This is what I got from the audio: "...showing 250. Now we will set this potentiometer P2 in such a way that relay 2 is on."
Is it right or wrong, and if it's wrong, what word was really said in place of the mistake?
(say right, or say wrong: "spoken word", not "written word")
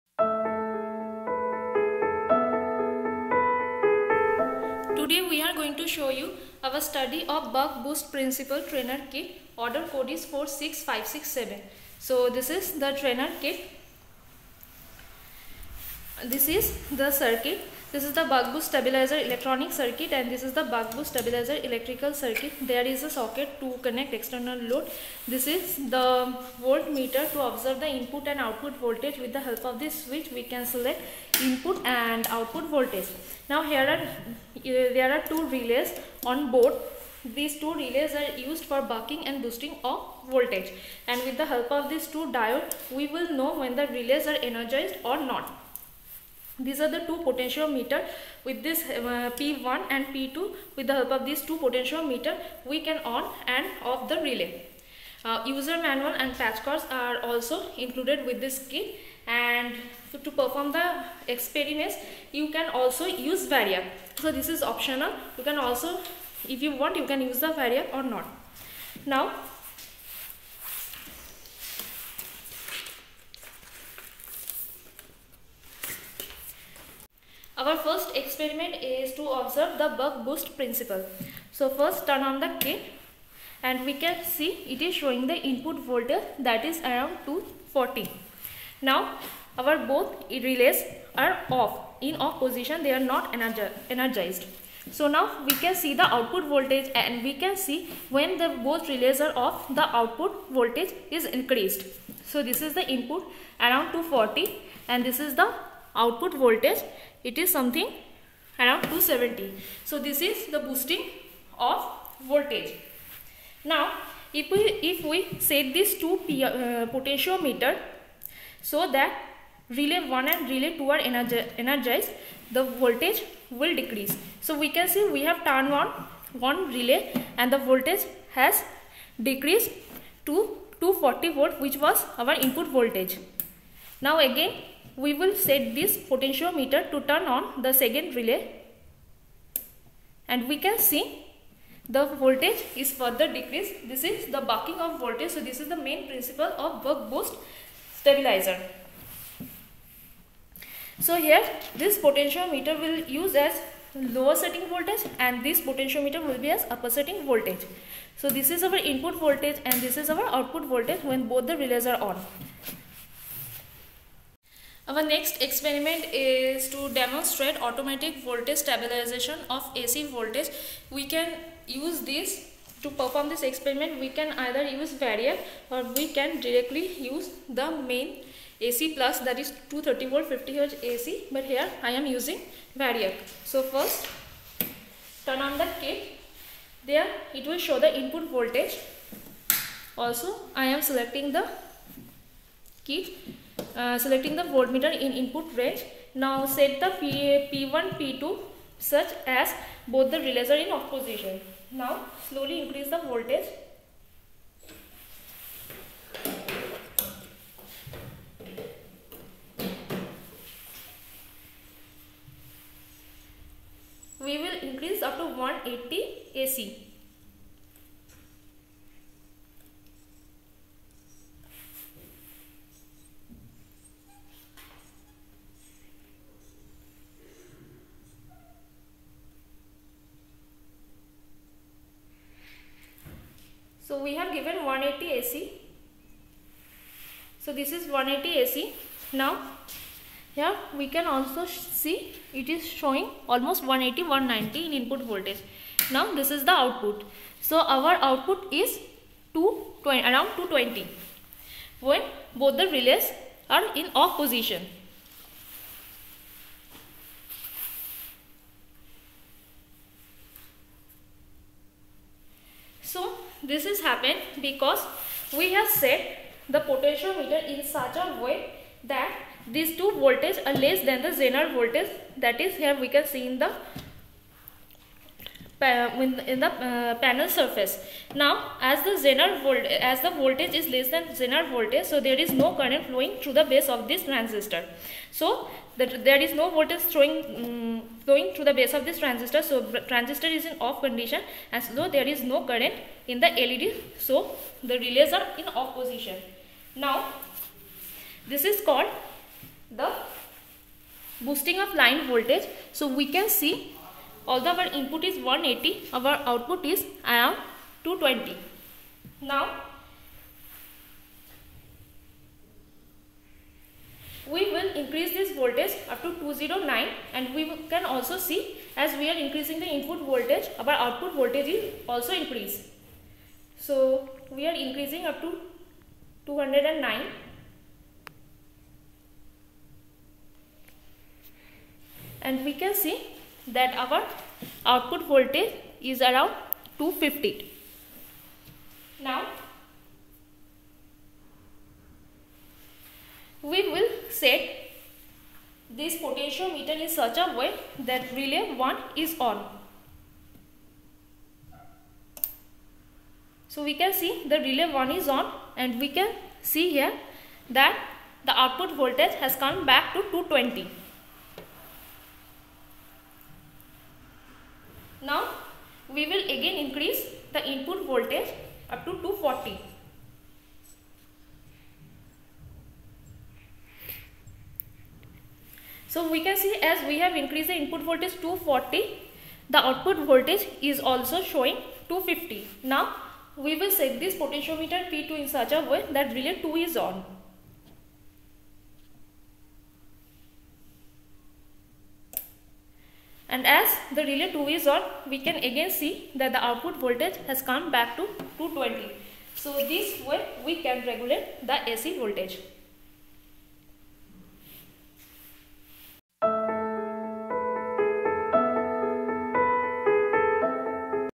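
right.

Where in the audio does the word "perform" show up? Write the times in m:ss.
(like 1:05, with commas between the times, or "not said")
1:00, 2:52.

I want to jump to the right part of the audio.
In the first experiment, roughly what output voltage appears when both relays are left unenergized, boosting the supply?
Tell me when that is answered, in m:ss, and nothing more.
1:48.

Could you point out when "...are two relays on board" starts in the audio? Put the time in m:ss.
0:35.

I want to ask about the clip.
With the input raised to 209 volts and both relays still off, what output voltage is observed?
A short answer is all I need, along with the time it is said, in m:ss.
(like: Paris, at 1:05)
250, at 5:36.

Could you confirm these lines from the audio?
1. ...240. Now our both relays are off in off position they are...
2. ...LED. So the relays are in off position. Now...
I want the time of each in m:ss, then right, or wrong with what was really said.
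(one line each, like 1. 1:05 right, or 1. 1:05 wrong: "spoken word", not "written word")
1. 1:27 right
2. 4:53 right.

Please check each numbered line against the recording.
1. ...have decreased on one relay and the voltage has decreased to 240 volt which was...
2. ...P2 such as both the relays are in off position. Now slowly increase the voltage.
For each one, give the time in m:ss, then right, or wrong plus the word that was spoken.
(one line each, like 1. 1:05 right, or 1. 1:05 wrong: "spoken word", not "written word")
1. 2:05 wrong: "turned", not "decreased"
2. 3:17 right.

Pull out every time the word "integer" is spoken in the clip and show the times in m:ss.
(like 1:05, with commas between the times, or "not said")
not said.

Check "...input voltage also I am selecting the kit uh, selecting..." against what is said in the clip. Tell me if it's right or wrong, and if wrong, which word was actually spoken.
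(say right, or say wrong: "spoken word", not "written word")
right.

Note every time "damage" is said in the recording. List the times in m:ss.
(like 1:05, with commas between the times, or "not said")
not said.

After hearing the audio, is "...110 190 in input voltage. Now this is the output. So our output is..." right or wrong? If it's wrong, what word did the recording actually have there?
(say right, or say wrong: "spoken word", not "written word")
wrong: "180", not "110".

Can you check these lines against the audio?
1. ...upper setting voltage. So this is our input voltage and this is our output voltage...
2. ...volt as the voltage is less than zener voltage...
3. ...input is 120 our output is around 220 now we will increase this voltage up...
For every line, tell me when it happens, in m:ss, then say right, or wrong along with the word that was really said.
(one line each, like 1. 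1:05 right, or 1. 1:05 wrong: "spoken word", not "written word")
1. 2:36 right
2. 4:39 right
3. 5:04 wrong: "180", not "120".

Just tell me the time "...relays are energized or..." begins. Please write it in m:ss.
0:43.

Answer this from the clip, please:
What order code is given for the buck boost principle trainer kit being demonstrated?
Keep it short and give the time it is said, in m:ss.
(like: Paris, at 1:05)
46567, at 0:10.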